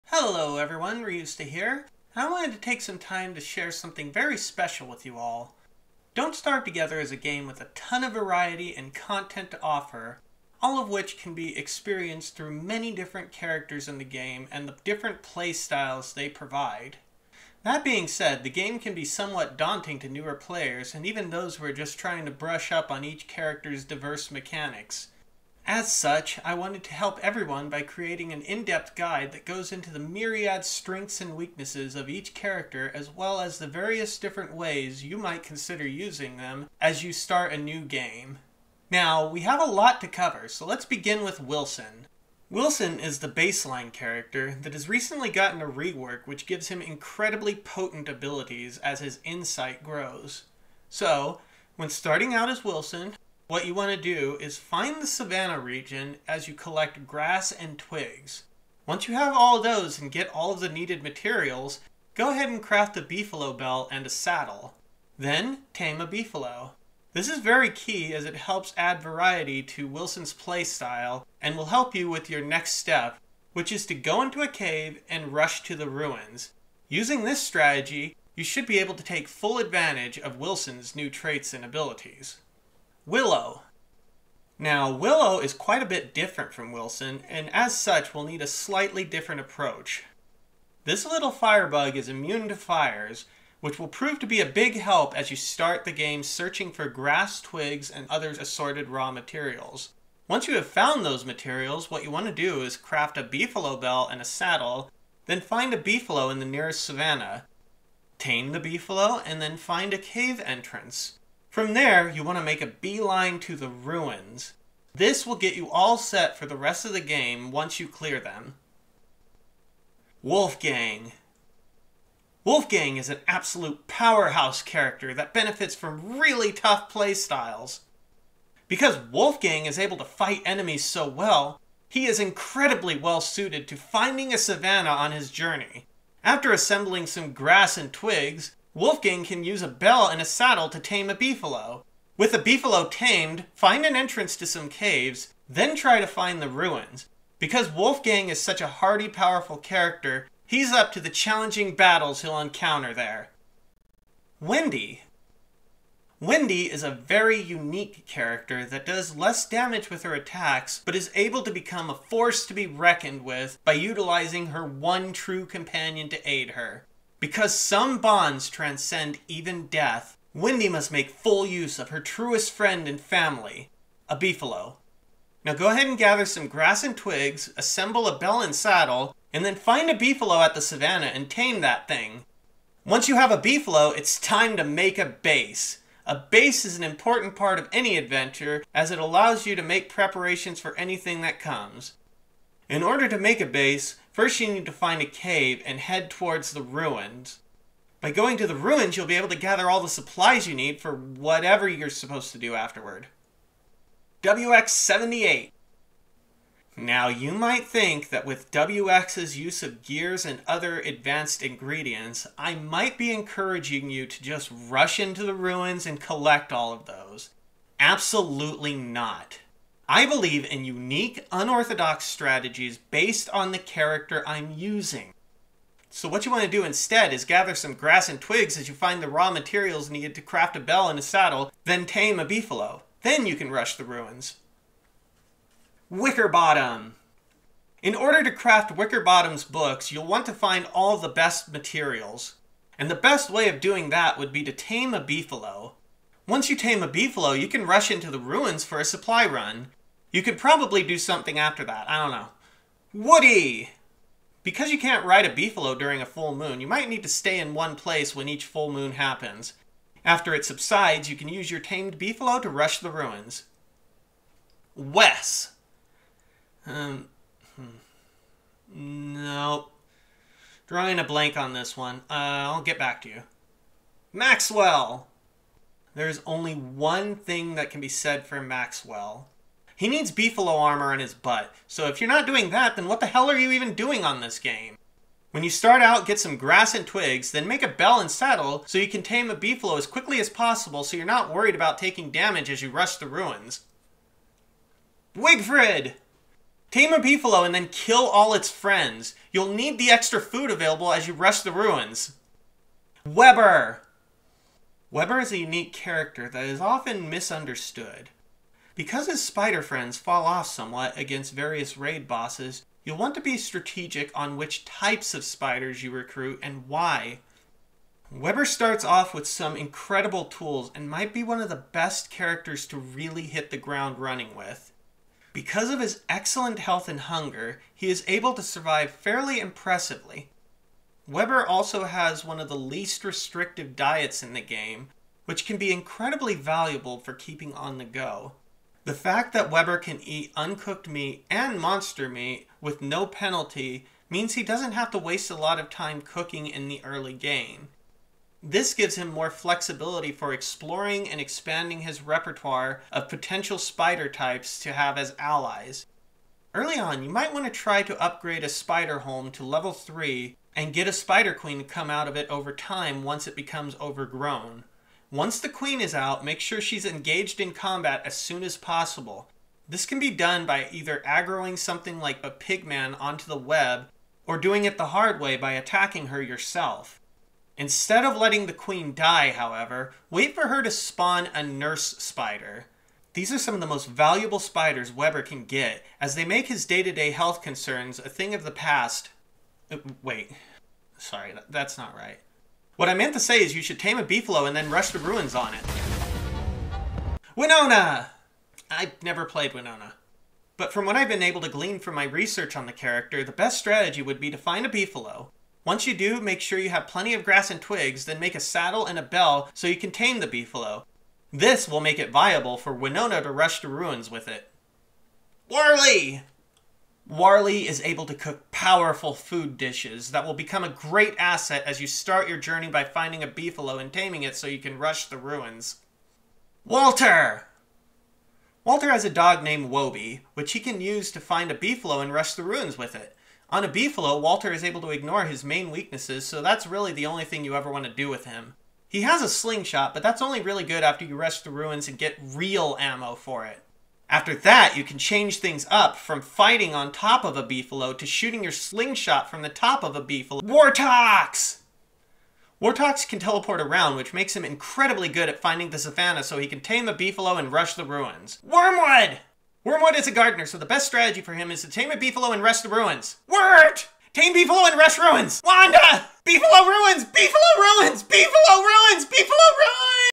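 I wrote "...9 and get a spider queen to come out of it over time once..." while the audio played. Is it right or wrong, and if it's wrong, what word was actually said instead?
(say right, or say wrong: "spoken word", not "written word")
wrong: "3", not "9".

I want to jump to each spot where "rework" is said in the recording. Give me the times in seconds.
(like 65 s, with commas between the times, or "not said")
45 s.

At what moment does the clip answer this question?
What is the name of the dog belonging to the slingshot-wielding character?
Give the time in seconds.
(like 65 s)
429 s.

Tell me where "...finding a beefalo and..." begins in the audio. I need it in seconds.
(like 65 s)
422 s.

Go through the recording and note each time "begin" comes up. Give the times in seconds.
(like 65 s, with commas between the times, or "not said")
40 s.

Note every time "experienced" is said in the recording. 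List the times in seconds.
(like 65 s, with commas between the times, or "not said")
11 s.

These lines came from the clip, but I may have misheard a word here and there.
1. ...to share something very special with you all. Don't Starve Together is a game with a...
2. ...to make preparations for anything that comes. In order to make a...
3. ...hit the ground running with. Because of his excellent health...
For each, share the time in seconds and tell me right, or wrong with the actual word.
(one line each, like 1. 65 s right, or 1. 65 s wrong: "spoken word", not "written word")
1. 3 s right
2. 189 s right
3. 323 s right.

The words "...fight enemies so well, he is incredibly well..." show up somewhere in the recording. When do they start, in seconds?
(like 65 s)
130 s.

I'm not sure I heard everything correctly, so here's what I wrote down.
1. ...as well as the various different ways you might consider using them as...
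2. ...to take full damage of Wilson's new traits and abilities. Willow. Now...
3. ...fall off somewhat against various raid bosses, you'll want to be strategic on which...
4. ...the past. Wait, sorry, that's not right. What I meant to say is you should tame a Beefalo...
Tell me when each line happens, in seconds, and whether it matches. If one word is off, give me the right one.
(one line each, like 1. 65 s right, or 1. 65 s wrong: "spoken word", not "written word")
1. 32 s right
2. 78 s wrong: "advantage", not "damage"
3. 309 s right
4. 388 s right.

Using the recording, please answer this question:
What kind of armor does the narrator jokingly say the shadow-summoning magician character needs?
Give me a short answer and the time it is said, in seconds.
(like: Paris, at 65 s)
beefalo armor, at 280 s.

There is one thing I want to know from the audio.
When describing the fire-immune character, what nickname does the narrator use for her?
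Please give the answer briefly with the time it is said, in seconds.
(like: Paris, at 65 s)
firebug, at 91 s.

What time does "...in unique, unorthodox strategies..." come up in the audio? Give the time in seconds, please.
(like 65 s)
220 s.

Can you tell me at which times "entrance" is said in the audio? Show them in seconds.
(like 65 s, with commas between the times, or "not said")
110 s, 143 s.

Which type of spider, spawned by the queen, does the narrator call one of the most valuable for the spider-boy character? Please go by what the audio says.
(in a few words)
nurse spider.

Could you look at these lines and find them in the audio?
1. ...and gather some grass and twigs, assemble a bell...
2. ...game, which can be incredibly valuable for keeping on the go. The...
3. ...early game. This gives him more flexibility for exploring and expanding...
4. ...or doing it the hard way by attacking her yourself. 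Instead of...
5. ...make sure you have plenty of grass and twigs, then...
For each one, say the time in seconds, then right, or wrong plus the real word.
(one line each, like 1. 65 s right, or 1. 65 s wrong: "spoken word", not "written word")
1. 175 s right
2. 334 s right
3. 346 s right
4. 374 s right
5. 406 s right.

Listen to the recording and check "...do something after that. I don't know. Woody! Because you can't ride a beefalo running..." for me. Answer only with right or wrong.
wrong.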